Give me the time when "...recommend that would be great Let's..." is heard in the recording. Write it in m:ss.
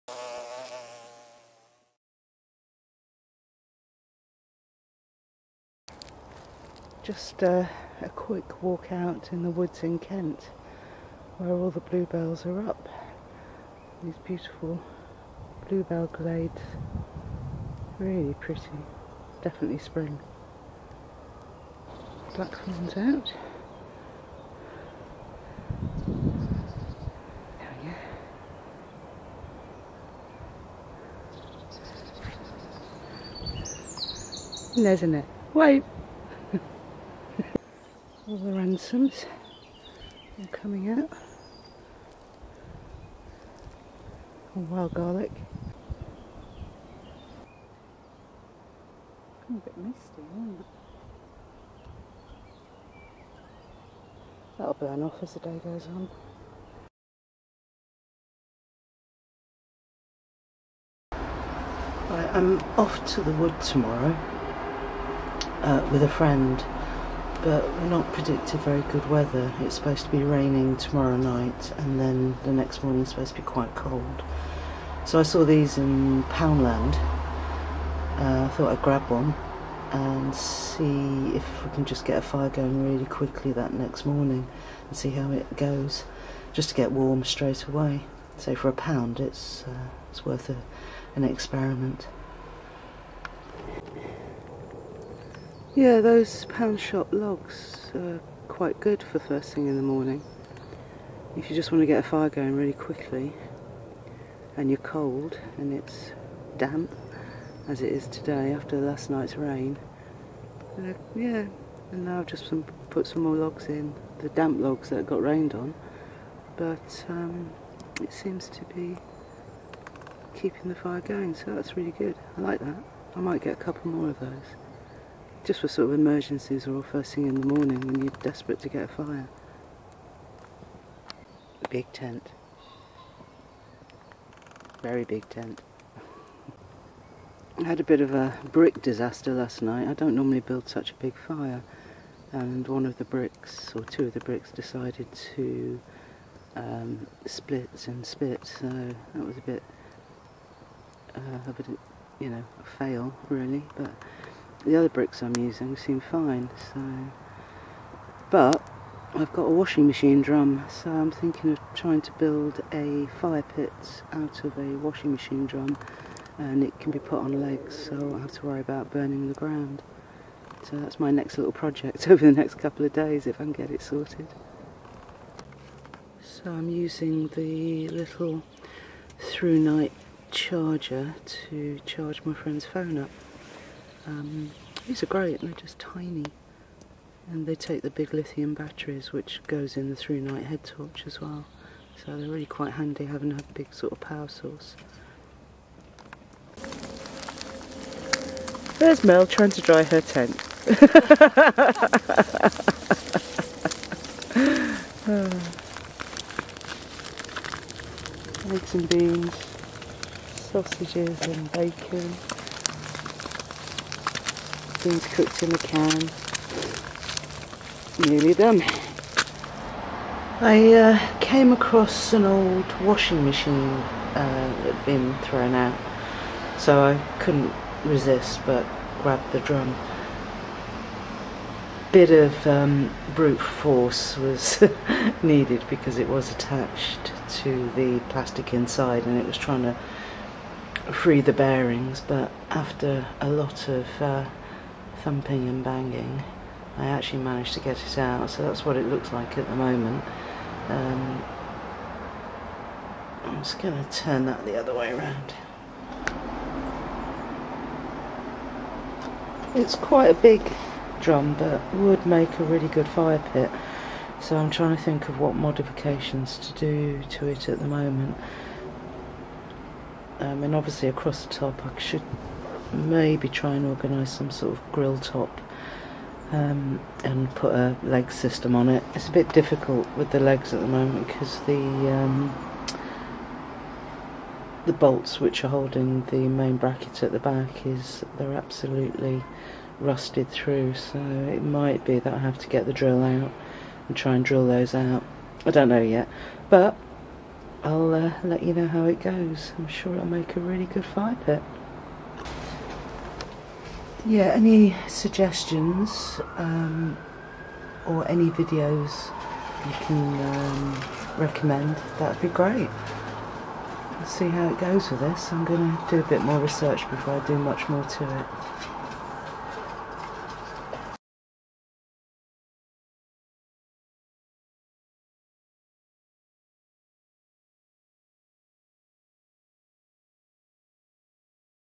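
5:11.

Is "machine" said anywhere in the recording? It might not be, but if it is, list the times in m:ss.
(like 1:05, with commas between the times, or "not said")
2:39, 2:45, 3:43.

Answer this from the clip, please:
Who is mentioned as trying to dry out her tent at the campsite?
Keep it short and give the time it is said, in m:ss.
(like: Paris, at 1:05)
Mel, at 3:19.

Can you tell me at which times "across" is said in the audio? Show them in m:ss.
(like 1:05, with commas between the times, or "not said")
3:41, 4:30.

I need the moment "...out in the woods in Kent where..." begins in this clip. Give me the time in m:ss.
0:08.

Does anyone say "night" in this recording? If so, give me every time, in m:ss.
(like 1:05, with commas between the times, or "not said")
1:11, 1:49, 2:19.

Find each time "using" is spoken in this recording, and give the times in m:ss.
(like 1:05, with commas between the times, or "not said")
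2:35, 2:56.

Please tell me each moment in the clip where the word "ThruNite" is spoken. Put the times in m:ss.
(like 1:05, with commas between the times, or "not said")
2:59, 3:09.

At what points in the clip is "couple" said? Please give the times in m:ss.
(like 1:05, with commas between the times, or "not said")
2:03, 2:52.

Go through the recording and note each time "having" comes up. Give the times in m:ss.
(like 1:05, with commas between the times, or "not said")
3:13.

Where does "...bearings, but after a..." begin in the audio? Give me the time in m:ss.
4:01.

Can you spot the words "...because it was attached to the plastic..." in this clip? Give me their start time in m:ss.
3:55.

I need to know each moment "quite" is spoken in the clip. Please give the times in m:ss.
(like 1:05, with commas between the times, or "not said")
1:13, 1:38, 3:12, 4:19.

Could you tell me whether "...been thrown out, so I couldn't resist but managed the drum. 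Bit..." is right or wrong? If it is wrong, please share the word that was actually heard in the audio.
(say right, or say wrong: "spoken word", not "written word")
wrong: "grabbed", not "managed".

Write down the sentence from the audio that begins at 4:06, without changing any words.
I actually managed to get it out, so that's what it looks like at the moment.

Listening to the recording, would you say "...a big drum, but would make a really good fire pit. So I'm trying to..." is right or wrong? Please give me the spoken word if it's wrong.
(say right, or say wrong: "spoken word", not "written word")
right.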